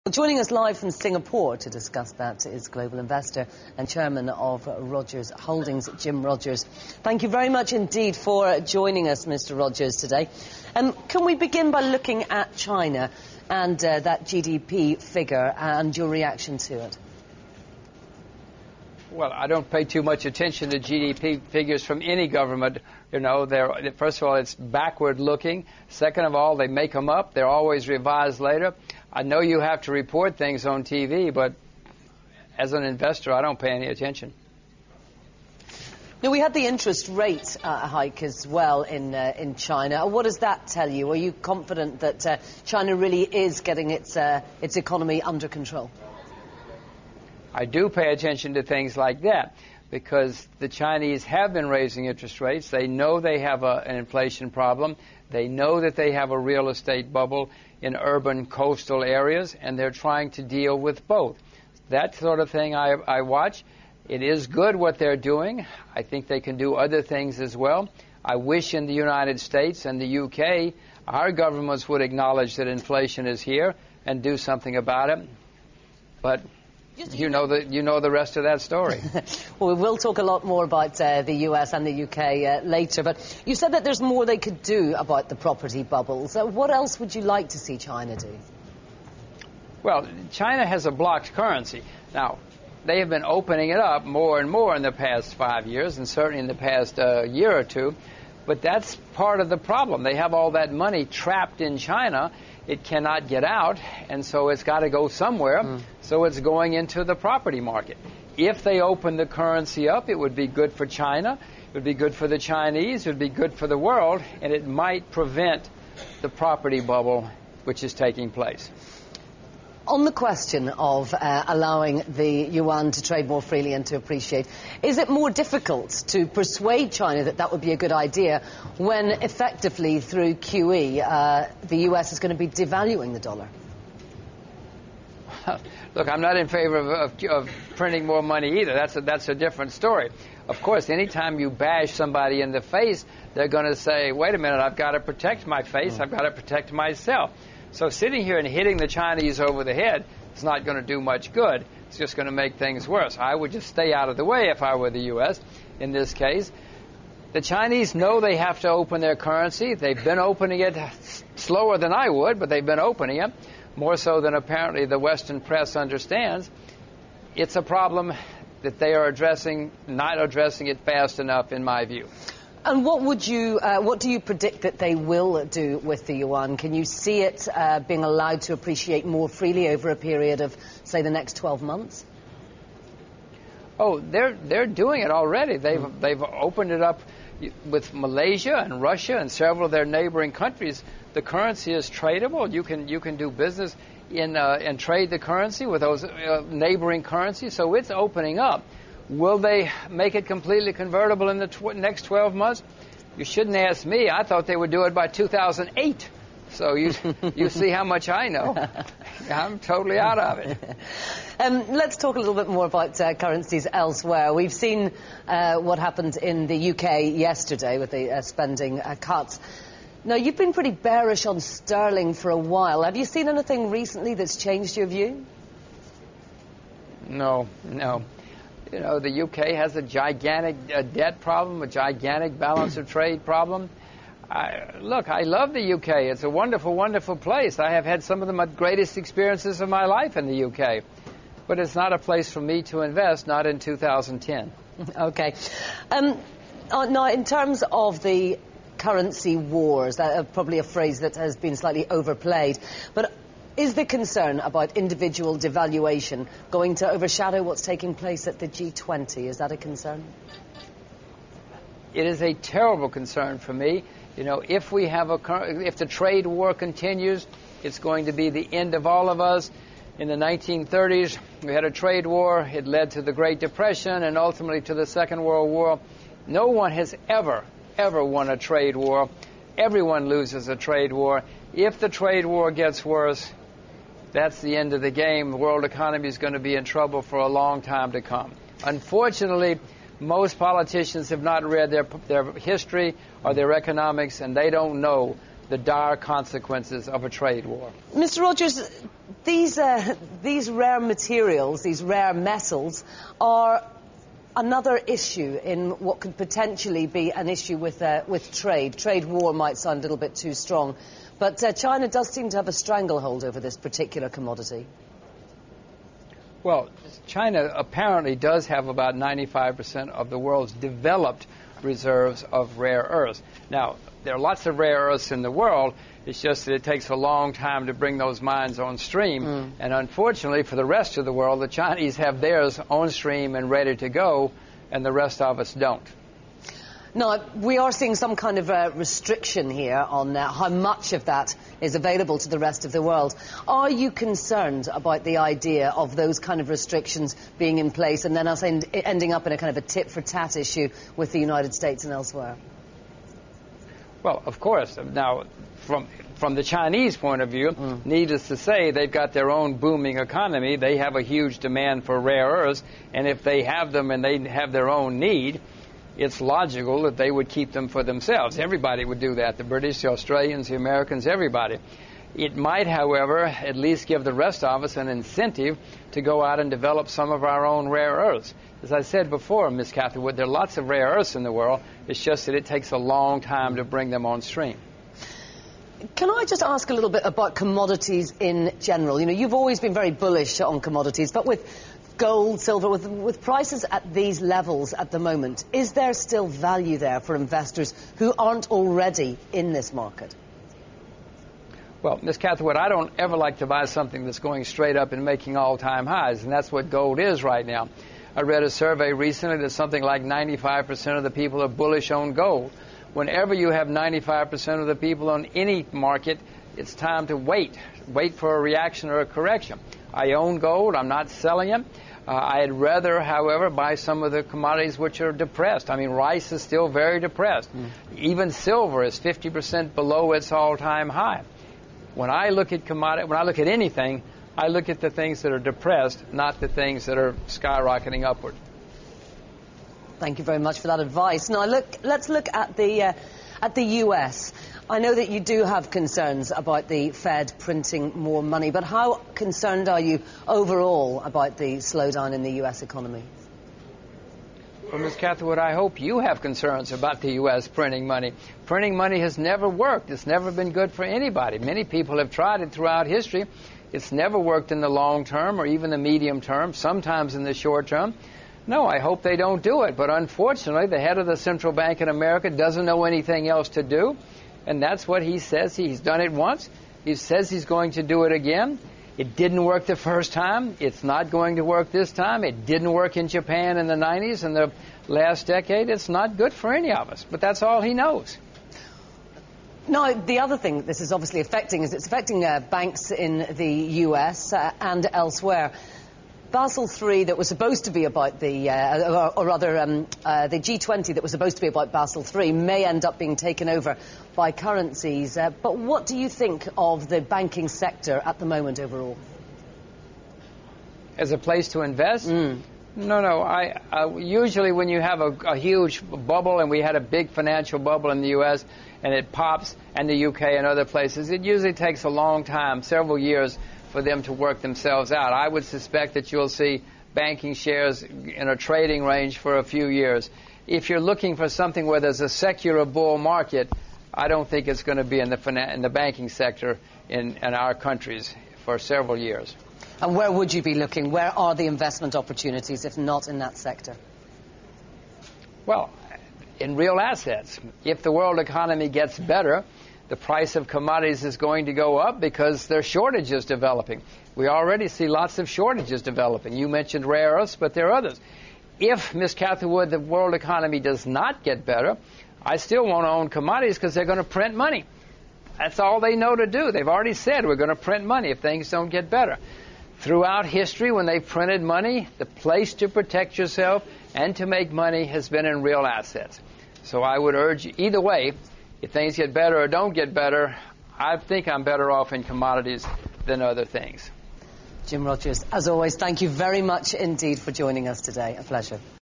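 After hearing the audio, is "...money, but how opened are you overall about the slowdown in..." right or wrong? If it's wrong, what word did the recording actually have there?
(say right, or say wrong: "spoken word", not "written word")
wrong: "concerned", not "opened".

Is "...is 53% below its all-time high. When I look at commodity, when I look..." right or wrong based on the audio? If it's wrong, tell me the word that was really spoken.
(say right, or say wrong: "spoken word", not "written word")
wrong: "50", not "53".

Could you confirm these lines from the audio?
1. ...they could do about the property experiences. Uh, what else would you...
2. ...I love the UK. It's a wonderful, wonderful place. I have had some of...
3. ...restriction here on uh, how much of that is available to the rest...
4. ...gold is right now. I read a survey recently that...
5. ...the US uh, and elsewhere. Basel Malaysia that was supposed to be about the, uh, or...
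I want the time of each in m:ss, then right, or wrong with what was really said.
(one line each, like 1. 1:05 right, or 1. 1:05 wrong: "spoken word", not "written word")
1. 1:24 wrong: "bubbles", not "experiences"
2. 3:55 right
3. 5:38 right
4. 6:46 right
5. 8:13 wrong: "III", not "Malaysia".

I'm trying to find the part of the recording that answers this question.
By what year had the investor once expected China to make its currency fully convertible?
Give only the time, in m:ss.
3:25.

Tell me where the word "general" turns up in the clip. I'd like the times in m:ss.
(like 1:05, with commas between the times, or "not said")
6:28.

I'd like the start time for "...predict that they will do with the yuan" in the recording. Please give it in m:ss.
2:54.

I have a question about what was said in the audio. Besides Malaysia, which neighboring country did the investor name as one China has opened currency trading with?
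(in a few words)
Russia.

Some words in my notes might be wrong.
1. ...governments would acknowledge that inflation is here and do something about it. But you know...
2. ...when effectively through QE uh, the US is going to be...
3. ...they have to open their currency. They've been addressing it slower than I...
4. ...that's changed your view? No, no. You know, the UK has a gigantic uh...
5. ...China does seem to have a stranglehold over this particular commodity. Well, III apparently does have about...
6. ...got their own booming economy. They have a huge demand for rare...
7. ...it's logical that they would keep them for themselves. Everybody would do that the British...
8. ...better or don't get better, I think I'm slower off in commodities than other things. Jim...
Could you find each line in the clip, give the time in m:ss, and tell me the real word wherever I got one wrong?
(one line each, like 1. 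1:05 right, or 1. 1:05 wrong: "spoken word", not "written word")
1. 1:11 right
2. 2:08 right
3. 2:38 wrong: "opening", not "addressing"
4. 3:44 right
5. 5:11 wrong: "China", not "III"
6. 5:58 right
7. 6:06 right
8. 9:39 wrong: "better", not "slower".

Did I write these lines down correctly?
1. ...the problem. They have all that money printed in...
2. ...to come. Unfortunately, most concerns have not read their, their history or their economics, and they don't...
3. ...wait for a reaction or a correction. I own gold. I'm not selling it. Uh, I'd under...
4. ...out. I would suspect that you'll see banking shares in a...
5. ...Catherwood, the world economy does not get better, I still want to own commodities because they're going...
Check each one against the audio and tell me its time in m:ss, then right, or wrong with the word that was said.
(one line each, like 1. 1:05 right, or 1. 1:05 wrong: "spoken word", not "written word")
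1. 1:39 wrong: "trapped", not "printed"
2. 4:47 wrong: "politicians", not "concerns"
3. 6:57 wrong: "rather", not "under"
4. 8:44 right
5. 9:19 right.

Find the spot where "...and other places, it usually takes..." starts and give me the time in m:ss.
8:40.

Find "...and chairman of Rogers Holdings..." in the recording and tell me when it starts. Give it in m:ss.
0:03.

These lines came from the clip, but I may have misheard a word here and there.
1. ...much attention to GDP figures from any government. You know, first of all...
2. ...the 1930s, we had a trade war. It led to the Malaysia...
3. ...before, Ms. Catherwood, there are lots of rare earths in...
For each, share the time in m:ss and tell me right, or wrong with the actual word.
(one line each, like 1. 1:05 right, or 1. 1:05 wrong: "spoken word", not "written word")
1. 0:20 right
2. 4:30 wrong: "Great", not "Malaysia"
3. 6:19 right.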